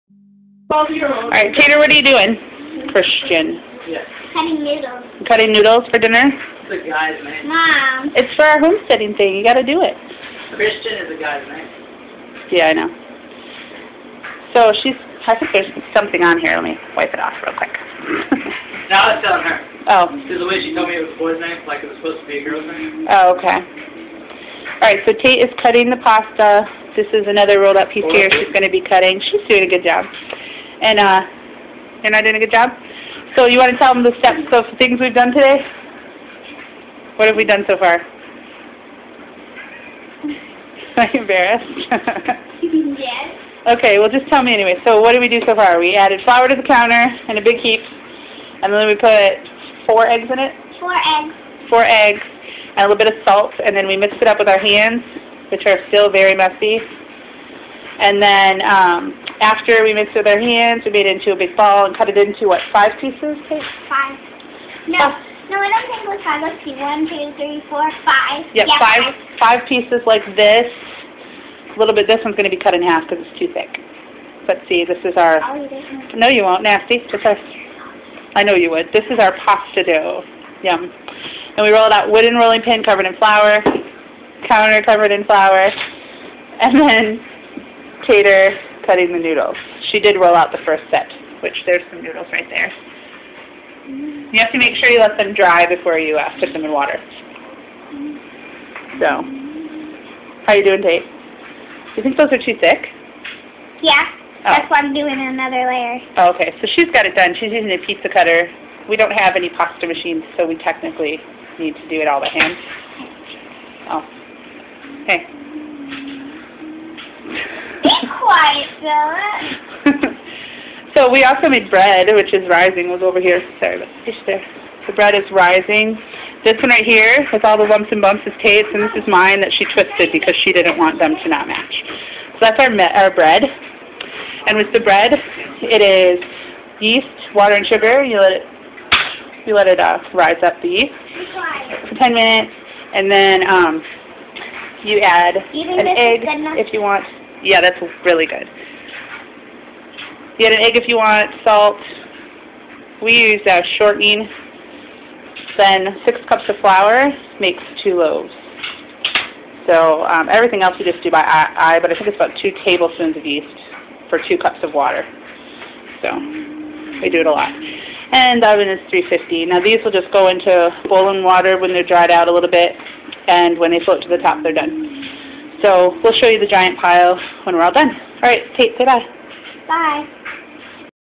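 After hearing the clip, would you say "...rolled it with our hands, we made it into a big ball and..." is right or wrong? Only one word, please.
wrong.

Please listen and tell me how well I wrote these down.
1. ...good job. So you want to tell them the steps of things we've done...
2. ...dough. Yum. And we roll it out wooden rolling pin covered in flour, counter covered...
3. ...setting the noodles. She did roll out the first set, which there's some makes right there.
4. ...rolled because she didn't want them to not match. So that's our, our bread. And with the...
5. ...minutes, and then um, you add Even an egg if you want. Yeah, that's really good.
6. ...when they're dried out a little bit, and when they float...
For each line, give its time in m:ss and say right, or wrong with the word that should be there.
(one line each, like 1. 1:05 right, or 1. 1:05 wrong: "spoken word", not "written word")
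1. 0:32 right
2. 1:19 right
3. 1:28 wrong: "noodles", not "makes"
4. 2:09 wrong: "twisted", not "rolled"
5. 2:22 right
6. 2:51 right.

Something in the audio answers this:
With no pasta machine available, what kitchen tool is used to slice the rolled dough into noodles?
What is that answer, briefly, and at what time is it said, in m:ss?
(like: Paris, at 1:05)
pizza cutter, at 1:47.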